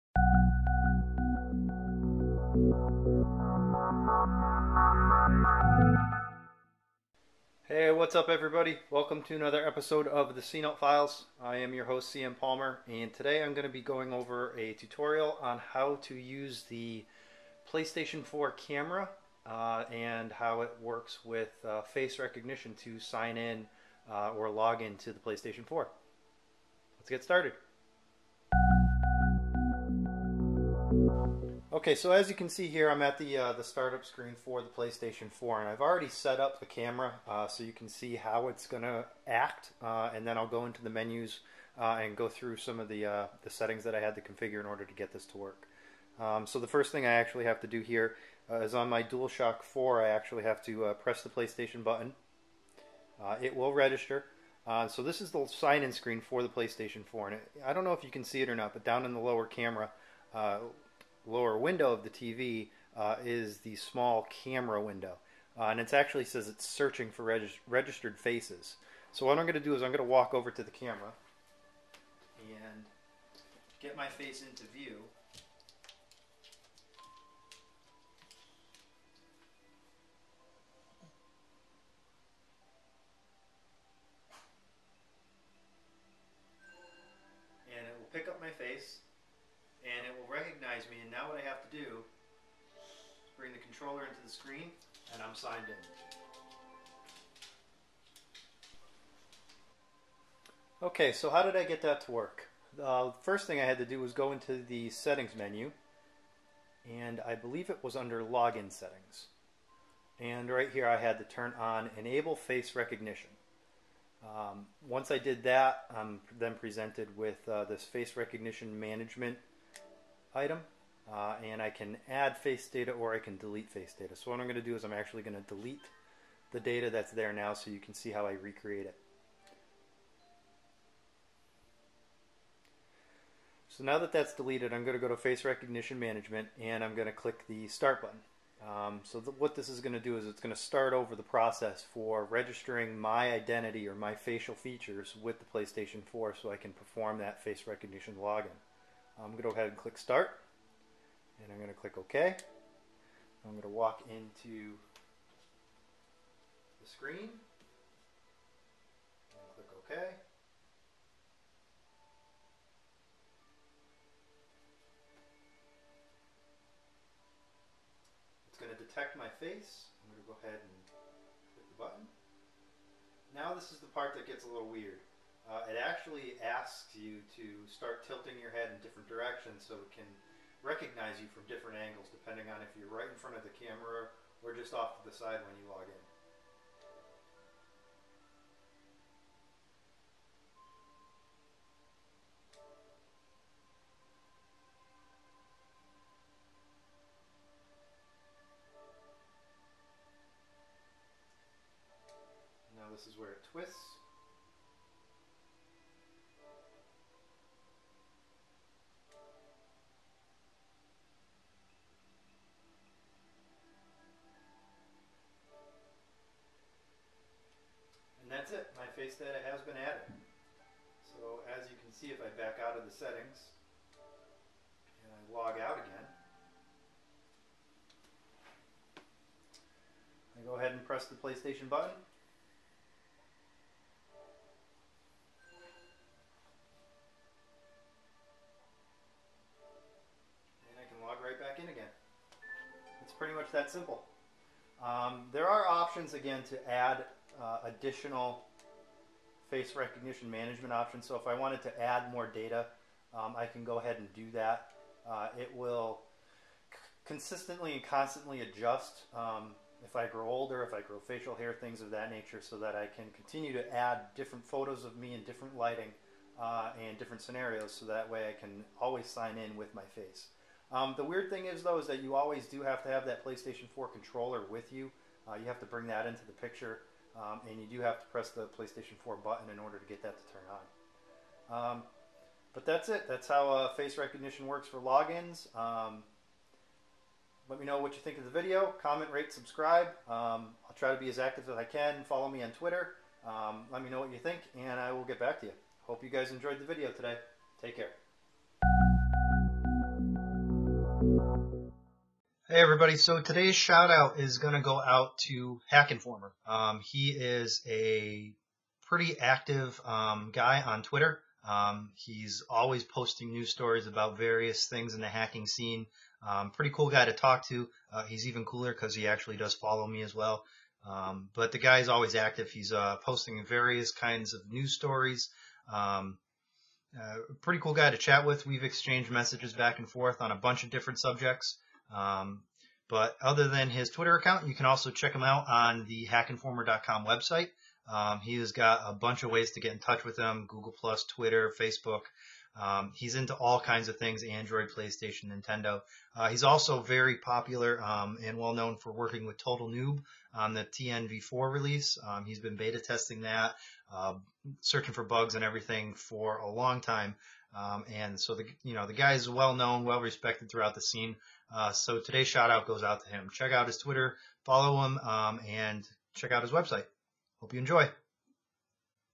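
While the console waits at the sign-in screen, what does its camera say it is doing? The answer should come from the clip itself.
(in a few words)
Searching for registered faces.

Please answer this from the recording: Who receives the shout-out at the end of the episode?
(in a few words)
Hack Informer.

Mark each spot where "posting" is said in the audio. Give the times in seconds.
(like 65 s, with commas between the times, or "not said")
312 s, 322 s.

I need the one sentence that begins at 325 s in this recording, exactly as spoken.
Um, uh, pretty cool guy to chat with.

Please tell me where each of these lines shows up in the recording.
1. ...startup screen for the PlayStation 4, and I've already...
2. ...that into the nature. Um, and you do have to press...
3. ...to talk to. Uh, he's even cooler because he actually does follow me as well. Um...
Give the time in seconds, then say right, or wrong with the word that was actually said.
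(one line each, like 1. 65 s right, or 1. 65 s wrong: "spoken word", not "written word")
1. 33 s right
2. 275 s wrong: "picture", not "nature"
3. 317 s right.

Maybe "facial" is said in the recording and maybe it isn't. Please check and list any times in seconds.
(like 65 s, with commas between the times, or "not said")
144 s, 261 s.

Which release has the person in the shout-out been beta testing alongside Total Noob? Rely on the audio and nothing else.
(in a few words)
TNV4.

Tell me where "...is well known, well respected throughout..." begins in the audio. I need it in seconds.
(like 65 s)
359 s.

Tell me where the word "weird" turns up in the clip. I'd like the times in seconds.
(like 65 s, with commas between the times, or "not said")
174 s, 271 s.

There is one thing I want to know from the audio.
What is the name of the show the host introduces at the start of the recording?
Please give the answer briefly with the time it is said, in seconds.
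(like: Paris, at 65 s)
The C-Note Files, at 10 s.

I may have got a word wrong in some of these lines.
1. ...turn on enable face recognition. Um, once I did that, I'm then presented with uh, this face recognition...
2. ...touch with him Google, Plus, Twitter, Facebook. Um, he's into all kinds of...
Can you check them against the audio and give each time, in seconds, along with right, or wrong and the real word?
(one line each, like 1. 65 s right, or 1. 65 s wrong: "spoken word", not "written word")
1. 111 s right
2. 339 s right.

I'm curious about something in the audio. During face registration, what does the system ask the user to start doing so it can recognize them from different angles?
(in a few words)
Tilting your head.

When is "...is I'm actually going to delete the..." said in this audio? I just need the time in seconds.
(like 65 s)
124 s.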